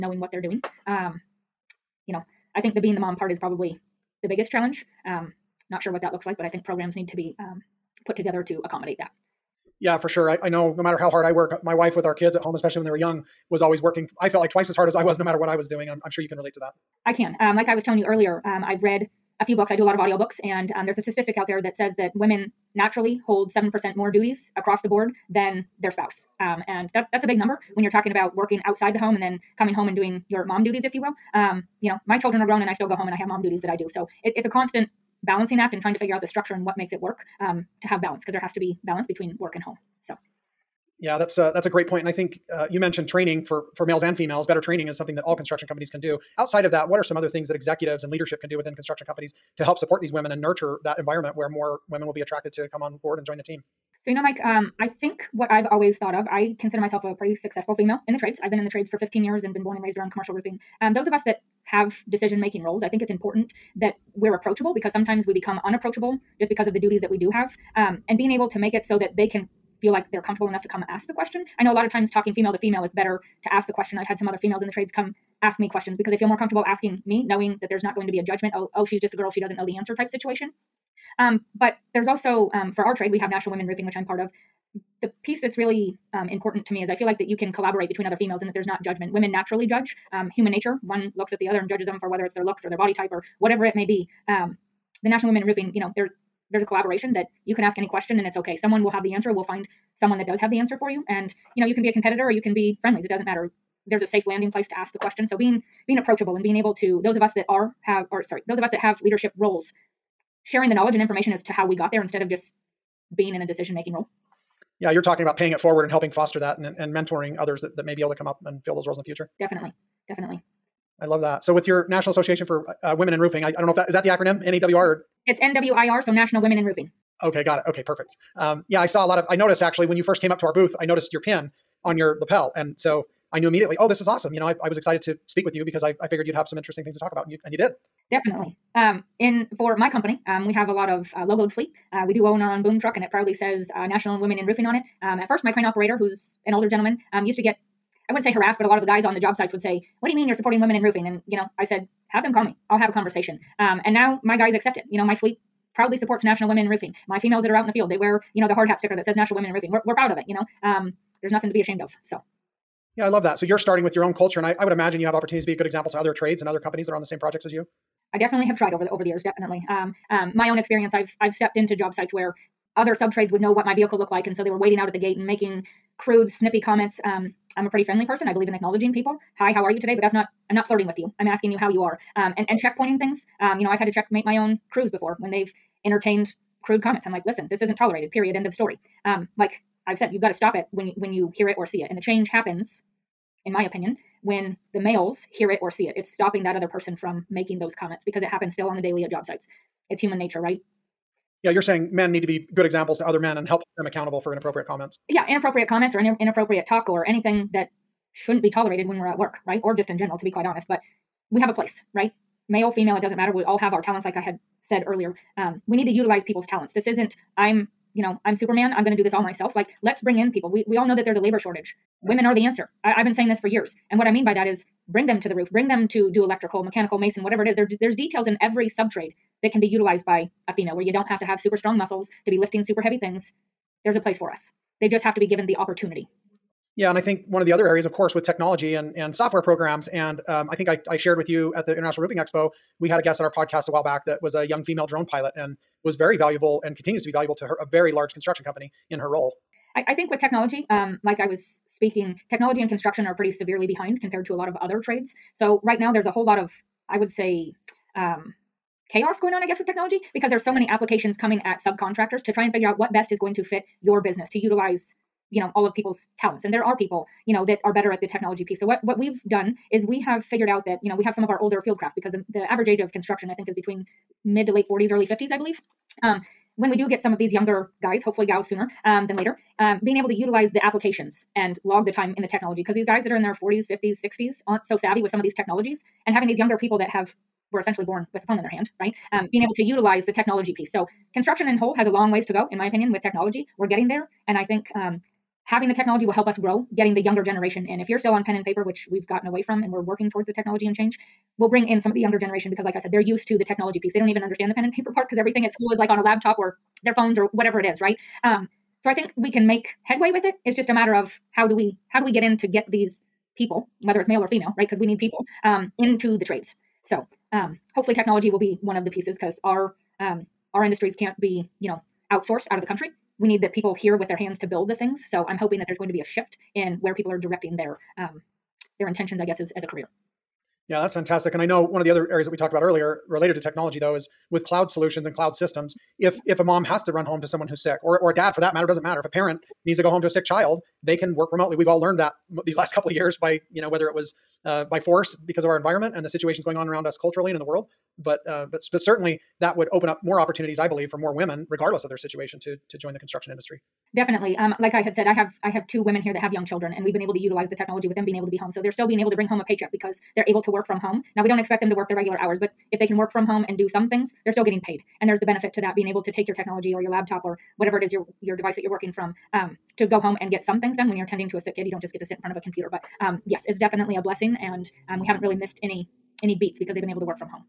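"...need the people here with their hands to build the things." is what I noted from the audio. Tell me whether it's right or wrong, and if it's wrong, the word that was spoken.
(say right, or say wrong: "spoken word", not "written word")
right.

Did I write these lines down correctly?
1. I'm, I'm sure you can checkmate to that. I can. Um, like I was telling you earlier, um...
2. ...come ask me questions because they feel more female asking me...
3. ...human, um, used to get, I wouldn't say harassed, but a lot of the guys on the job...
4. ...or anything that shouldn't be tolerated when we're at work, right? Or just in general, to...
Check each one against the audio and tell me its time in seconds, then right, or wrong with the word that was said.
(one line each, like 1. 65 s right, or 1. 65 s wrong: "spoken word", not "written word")
1. 15 s wrong: "relate", not "checkmate"
2. 74 s wrong: "comfortable", not "female"
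3. 146 s wrong: "gentleman", not "human"
4. 206 s right.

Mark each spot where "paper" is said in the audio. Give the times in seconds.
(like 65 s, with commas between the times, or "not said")
298 s, 304 s.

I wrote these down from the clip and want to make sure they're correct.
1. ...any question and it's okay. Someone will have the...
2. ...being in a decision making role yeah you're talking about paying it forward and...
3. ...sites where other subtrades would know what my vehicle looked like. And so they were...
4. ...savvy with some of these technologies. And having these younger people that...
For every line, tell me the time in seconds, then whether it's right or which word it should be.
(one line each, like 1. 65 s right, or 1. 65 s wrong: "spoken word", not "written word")
1. 97 s right
2. 113 s right
3. 171 s right
4. 284 s right.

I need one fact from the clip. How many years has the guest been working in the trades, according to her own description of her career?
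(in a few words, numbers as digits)
15.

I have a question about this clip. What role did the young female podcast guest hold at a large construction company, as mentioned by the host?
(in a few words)
Drone pilot.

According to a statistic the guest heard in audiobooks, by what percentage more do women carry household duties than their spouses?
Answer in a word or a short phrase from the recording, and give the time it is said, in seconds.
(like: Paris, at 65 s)
7%, at 23 s.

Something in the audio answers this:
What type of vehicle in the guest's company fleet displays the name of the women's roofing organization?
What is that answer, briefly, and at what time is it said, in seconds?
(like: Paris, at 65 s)
Boom truck, at 142 s.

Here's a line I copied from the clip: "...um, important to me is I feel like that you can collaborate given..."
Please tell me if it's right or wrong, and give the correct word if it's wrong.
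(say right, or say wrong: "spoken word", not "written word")
wrong: "between", not "given".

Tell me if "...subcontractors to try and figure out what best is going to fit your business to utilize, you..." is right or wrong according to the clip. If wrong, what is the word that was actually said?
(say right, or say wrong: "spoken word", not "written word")
right.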